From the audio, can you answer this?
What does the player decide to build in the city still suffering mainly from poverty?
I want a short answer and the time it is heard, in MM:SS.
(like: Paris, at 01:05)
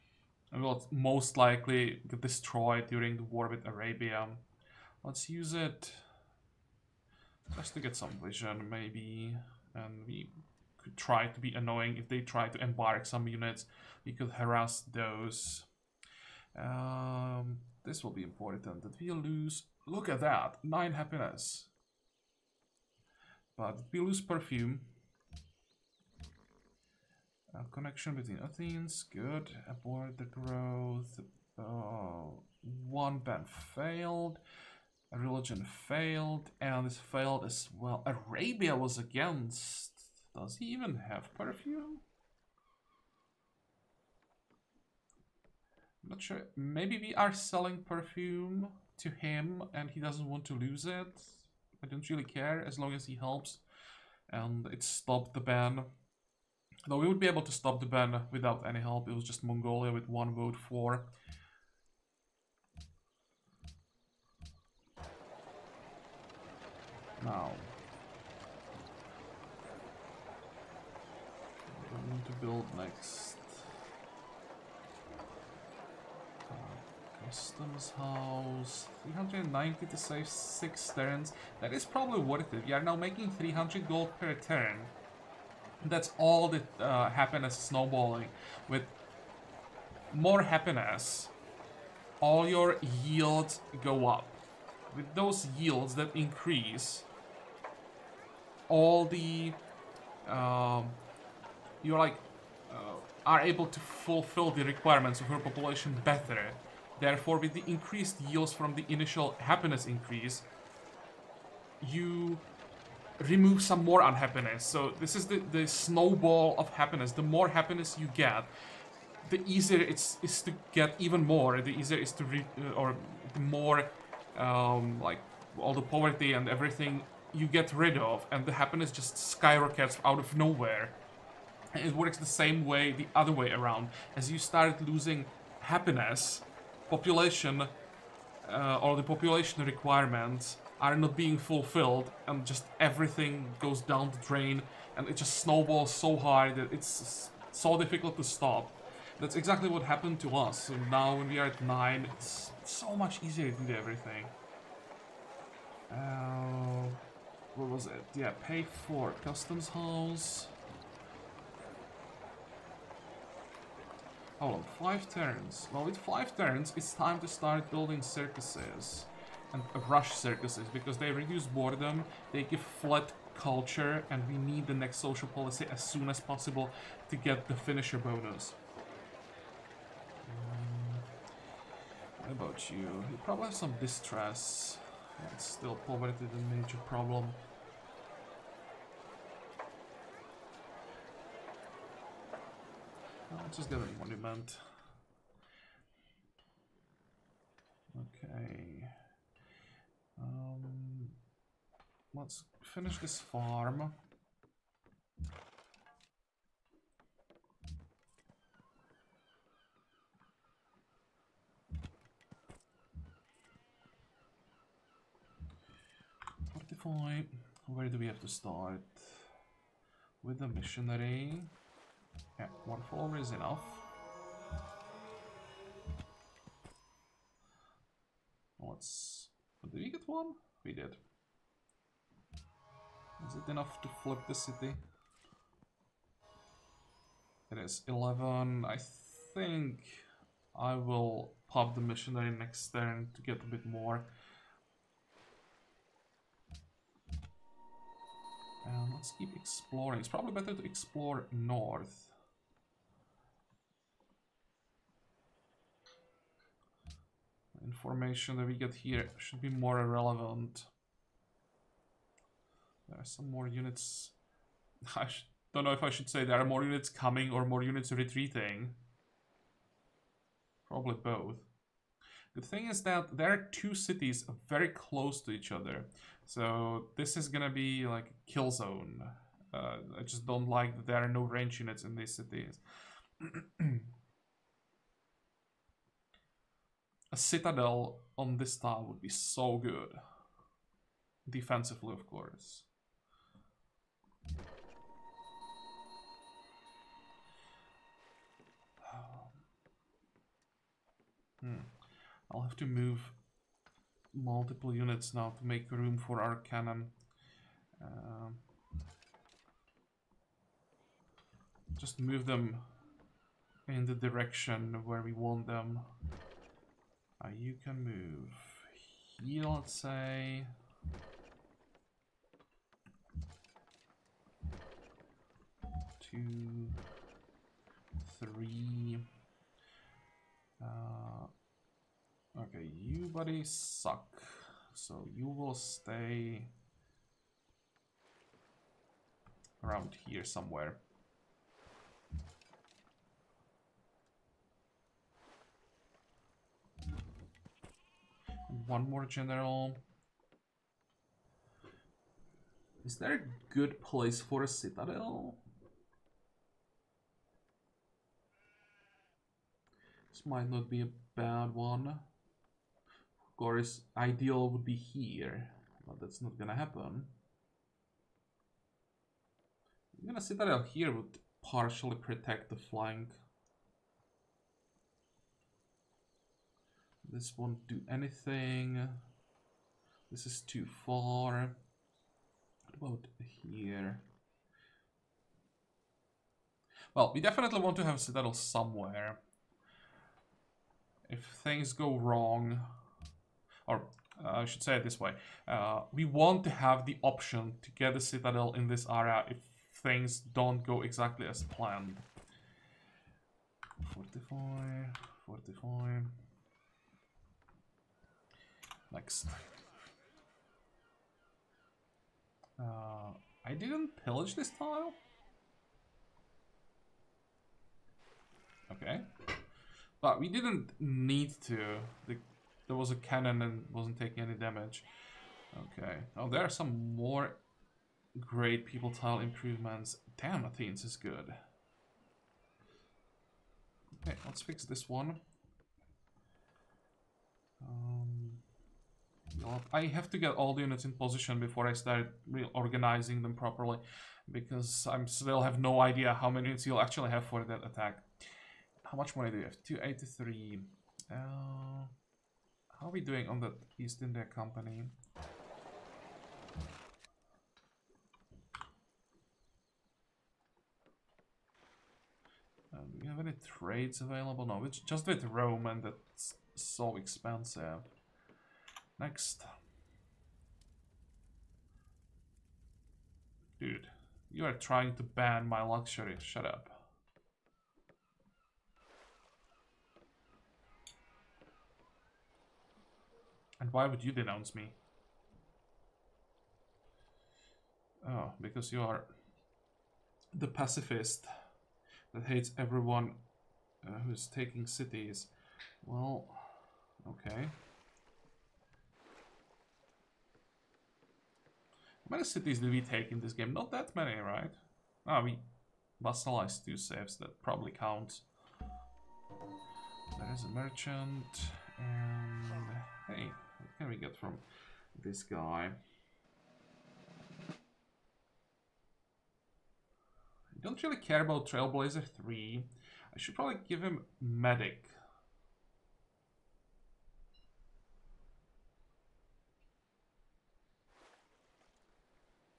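Monument, at 03:13.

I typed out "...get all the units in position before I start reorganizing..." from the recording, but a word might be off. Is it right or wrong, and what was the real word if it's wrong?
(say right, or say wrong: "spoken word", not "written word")
right.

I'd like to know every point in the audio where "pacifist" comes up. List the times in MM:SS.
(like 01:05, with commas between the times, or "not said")
08:10.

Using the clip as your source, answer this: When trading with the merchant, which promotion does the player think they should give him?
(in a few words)
Medic.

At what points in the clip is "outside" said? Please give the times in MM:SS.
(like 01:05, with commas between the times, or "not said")
not said.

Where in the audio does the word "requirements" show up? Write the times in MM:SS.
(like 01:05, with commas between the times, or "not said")
01:44, 02:19.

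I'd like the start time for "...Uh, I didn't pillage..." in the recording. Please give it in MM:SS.
06:52.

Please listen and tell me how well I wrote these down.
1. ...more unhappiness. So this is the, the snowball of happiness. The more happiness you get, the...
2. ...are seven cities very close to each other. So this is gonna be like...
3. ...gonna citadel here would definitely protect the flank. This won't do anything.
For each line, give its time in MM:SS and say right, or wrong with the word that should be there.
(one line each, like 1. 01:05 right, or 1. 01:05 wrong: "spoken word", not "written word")
1. 01:53 right
2. 04:33 wrong: "two", not "seven"
3. 06:10 wrong: "partially", not "definitely".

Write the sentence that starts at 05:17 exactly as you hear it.
Uh, you can move here, let's say.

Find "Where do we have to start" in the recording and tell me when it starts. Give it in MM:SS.
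03:37.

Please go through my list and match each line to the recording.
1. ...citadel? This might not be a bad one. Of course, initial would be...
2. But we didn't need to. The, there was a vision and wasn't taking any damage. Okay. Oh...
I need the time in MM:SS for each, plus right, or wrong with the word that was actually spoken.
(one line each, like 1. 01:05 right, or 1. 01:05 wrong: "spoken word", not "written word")
1. 05:54 wrong: "ideal", not "initial"
2. 06:59 wrong: "cannon", not "vision".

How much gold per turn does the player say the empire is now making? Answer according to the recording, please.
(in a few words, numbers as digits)
300.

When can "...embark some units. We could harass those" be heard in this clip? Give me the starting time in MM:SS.
00:12.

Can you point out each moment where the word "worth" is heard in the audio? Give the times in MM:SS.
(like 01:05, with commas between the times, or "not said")
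01:22.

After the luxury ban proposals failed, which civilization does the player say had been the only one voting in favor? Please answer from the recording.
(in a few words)
Mongolia.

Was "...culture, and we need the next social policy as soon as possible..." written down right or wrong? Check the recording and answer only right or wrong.
right.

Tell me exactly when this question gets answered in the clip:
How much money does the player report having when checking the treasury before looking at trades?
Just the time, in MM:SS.
07:29.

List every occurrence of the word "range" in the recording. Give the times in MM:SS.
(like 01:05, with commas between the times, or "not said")
04:41.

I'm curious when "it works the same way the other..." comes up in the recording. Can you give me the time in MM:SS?
02:11.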